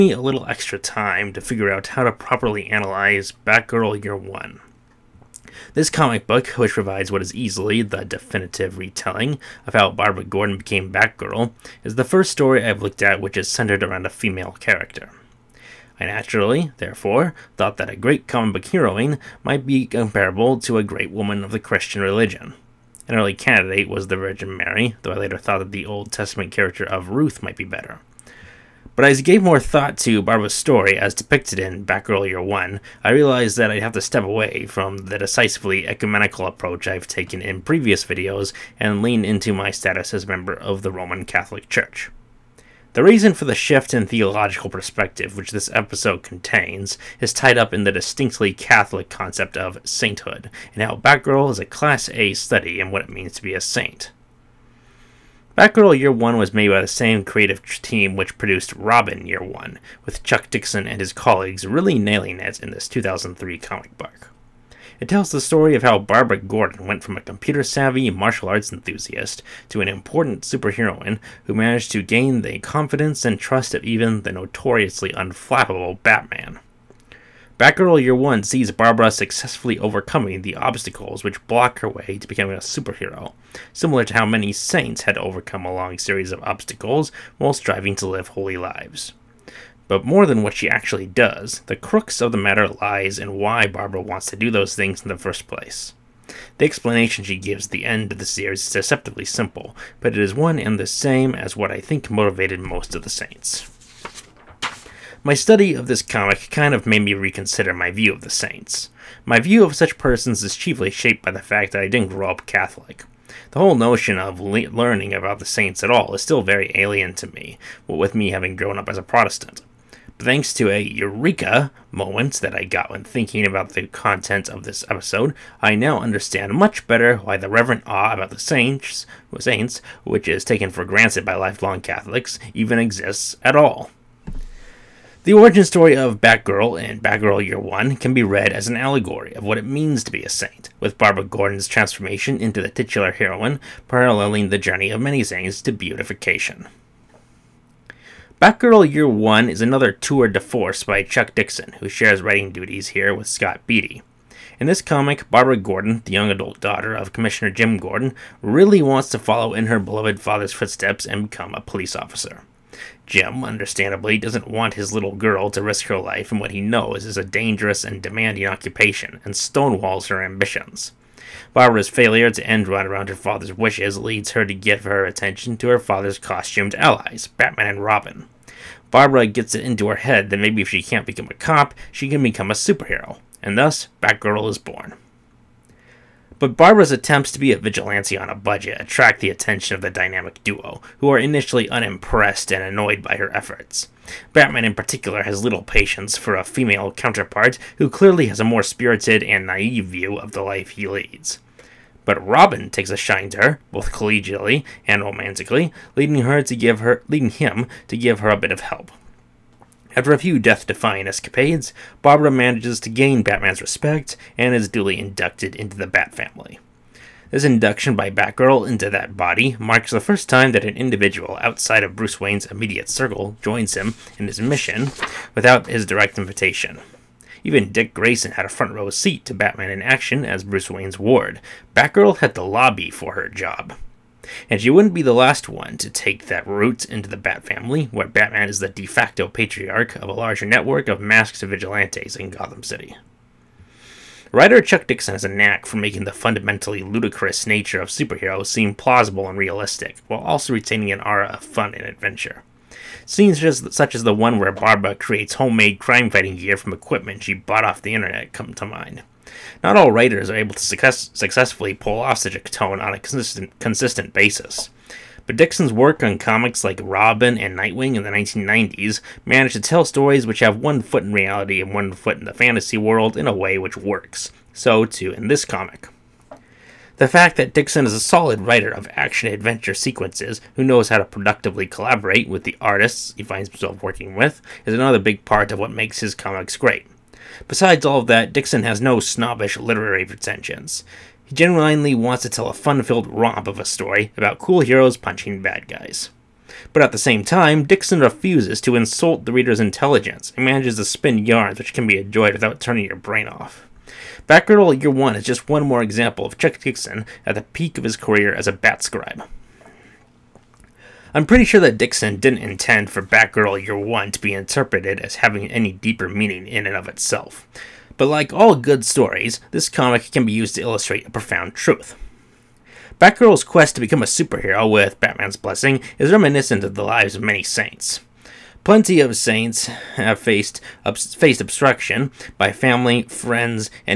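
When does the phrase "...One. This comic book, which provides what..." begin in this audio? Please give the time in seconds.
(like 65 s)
4 s.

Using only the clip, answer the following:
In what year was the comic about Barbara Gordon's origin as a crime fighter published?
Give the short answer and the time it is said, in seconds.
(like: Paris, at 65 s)
2003, at 62 s.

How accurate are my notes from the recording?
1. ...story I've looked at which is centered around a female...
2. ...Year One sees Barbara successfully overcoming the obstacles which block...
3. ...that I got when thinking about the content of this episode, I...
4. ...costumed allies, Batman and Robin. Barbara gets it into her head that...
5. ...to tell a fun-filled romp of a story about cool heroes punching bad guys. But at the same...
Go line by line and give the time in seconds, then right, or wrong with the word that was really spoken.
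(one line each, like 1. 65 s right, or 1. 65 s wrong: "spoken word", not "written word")
1. 12 s right
2. 78 s right
3. 122 s right
4. 176 s right
5. 292 s right.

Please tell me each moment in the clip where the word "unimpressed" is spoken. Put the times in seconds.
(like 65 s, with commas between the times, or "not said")
191 s.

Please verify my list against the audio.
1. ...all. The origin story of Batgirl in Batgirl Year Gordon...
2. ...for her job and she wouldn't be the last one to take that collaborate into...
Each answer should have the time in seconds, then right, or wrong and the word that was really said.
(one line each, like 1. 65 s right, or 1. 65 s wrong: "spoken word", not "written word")
1. 133 s wrong: "One", not "Gordon"
2. 232 s wrong: "route", not "collaborate".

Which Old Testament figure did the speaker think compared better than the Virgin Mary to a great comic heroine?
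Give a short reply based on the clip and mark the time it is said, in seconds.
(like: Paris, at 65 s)
Ruth, at 27 s.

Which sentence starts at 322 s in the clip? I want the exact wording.
Batgirl's quest to become a superhero with Batman's blessing is reminiscent of the lives of many saints.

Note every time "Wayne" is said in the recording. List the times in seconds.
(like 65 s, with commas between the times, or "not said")
222 s, 230 s.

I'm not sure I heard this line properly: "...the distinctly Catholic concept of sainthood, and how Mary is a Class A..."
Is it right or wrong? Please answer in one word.
wrong.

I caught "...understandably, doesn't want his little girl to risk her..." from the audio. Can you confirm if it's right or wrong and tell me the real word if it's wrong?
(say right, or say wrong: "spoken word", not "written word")
right.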